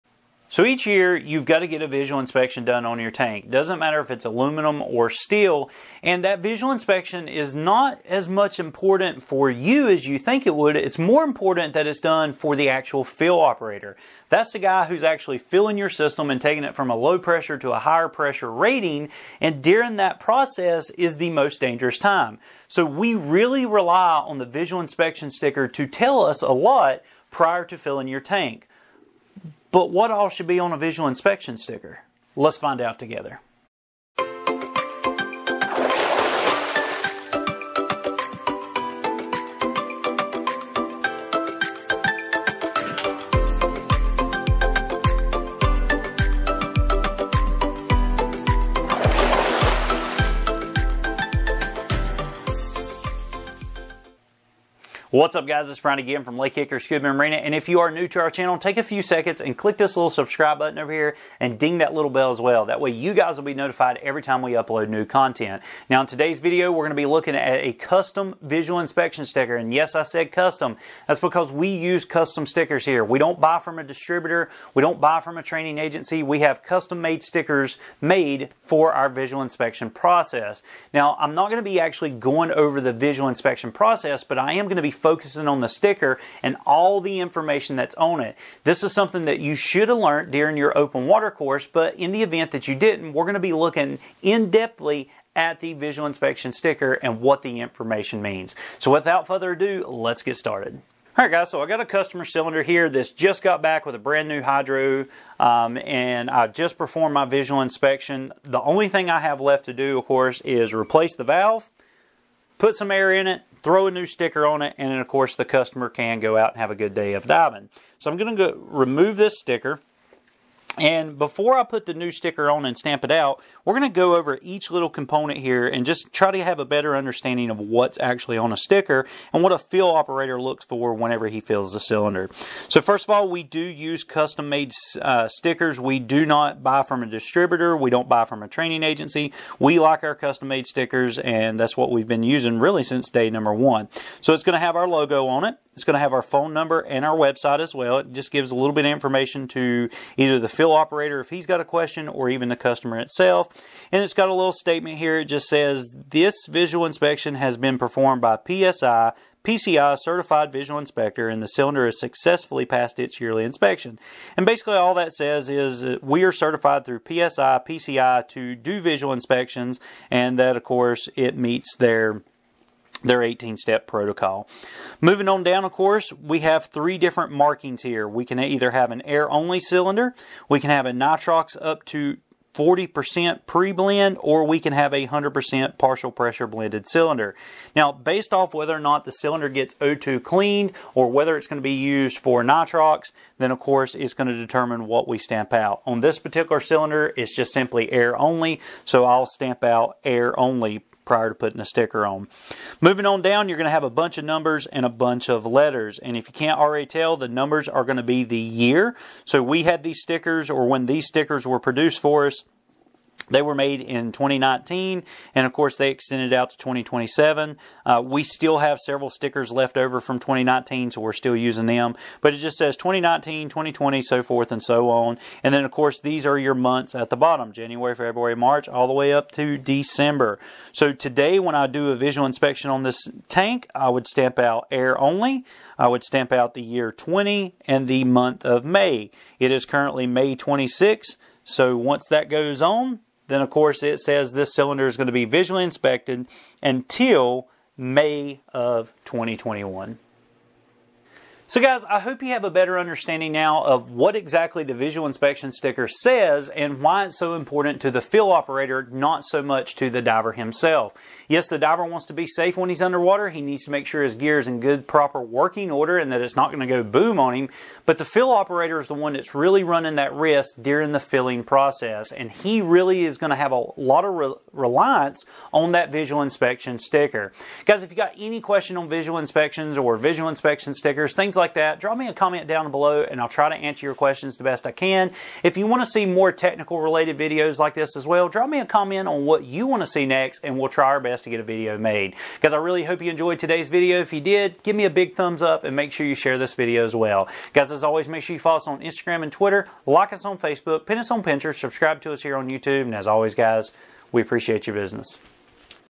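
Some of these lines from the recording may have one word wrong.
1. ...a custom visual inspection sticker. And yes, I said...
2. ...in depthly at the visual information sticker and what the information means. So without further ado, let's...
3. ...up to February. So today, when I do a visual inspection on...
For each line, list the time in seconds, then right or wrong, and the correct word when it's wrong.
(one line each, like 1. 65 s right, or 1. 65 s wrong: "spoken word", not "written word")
1. 67 s right
2. 94 s wrong: "inspection", not "information"
3. 229 s wrong: "December", not "February".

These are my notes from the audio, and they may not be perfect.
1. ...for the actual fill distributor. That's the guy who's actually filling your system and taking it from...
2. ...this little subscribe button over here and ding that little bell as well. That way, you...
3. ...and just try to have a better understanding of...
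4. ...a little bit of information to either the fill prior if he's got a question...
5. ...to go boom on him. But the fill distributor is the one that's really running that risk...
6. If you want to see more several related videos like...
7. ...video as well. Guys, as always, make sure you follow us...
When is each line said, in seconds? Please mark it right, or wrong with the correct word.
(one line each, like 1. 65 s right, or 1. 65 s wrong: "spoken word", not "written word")
1. 12 s wrong: "operator", not "distributor"
2. 59 s right
3. 125 s right
4. 148 s wrong: "operator", not "prior"
5. 266 s wrong: "operator", not "distributor"
6. 285 s wrong: "technical", not "several"
7. 296 s right.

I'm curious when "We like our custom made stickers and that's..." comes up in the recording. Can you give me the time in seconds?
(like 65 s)
139 s.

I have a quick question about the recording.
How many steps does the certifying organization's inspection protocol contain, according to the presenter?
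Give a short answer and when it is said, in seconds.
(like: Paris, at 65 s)
18, at 173 s.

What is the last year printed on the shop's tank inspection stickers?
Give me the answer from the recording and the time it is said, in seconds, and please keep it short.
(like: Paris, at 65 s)
2027, at 216 s.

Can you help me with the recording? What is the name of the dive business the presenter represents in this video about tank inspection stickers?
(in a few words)
Lake Hickory Scuba and Marina.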